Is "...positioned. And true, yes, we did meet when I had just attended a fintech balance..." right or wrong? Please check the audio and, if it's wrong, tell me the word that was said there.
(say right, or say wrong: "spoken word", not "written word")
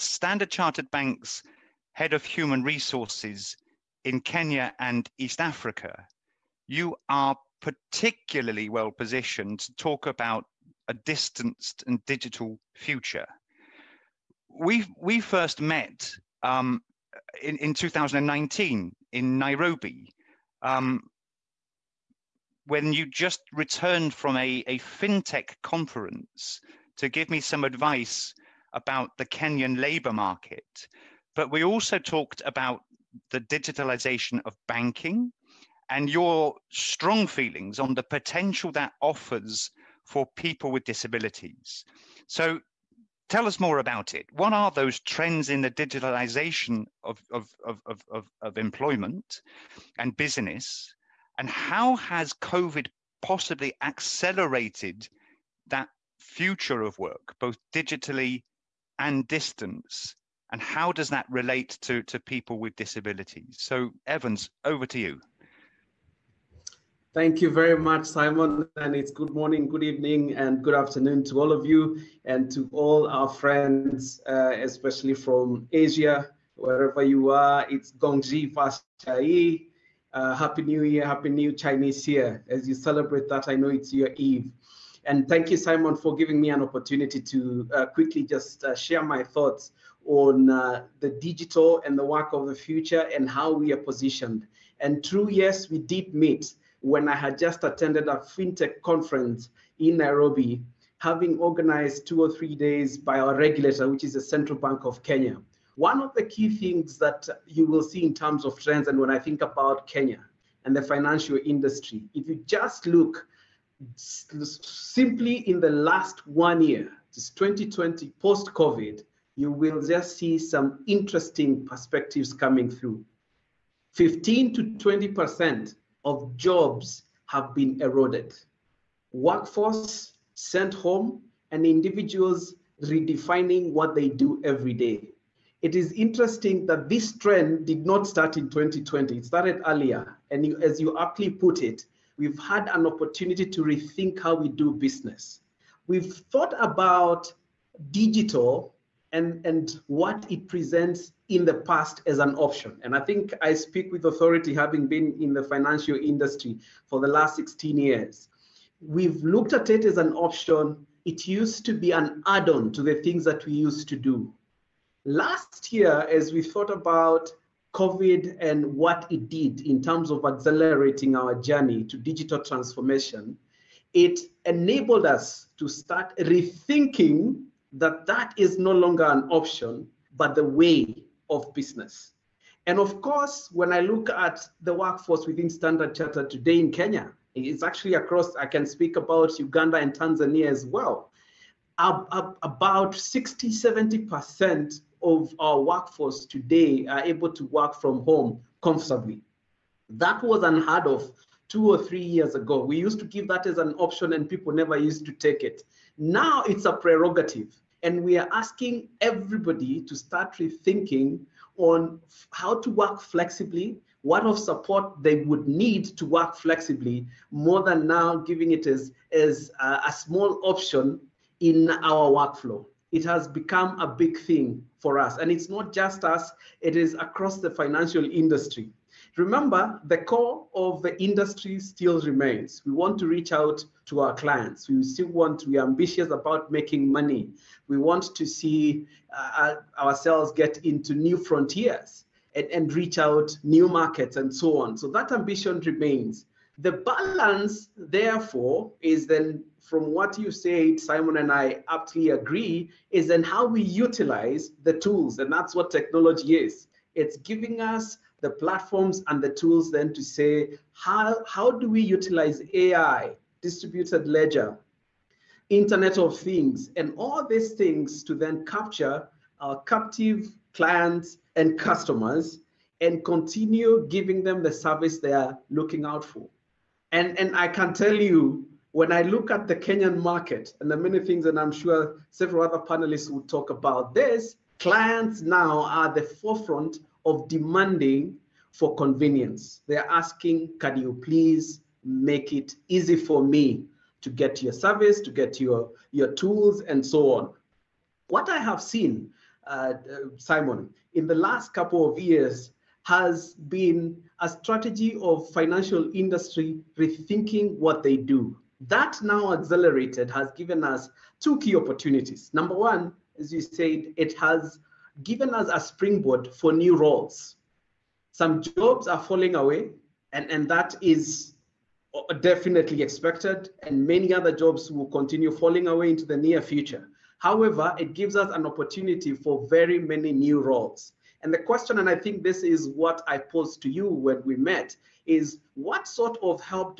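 wrong: "conference", not "balance".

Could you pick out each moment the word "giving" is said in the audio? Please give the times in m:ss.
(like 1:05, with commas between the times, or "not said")
1:26, 3:38, 4:17, 4:33.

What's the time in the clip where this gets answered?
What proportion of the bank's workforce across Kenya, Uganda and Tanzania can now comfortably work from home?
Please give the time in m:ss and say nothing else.
3:12.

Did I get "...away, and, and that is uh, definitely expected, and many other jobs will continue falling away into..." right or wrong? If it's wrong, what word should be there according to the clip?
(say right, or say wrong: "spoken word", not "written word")
right.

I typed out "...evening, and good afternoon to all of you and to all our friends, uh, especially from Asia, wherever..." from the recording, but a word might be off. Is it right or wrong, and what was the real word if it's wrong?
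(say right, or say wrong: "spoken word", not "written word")
right.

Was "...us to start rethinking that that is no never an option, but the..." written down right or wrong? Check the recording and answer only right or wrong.
wrong.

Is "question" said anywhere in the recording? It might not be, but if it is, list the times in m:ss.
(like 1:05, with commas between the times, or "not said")
5:31.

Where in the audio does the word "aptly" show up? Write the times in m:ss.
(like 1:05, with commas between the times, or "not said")
2:20, 4:11.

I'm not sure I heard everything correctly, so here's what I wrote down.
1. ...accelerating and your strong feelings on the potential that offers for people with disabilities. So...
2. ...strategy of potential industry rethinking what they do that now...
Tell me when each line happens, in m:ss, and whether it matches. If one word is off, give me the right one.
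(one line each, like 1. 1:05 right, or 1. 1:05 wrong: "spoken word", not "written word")
1. 0:34 wrong: "banking", not "accelerating"
2. 5:04 wrong: "financial", not "potential".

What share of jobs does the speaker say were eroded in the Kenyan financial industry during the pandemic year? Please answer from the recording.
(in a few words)
15 to 20%.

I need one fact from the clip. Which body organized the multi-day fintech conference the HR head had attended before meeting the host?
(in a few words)
Central Bank of Kenya.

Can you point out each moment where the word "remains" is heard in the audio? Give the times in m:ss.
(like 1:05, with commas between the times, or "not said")
3:52, 4:05.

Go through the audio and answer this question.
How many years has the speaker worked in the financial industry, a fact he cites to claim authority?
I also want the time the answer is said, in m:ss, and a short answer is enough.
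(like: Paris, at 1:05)
16, at 2:37.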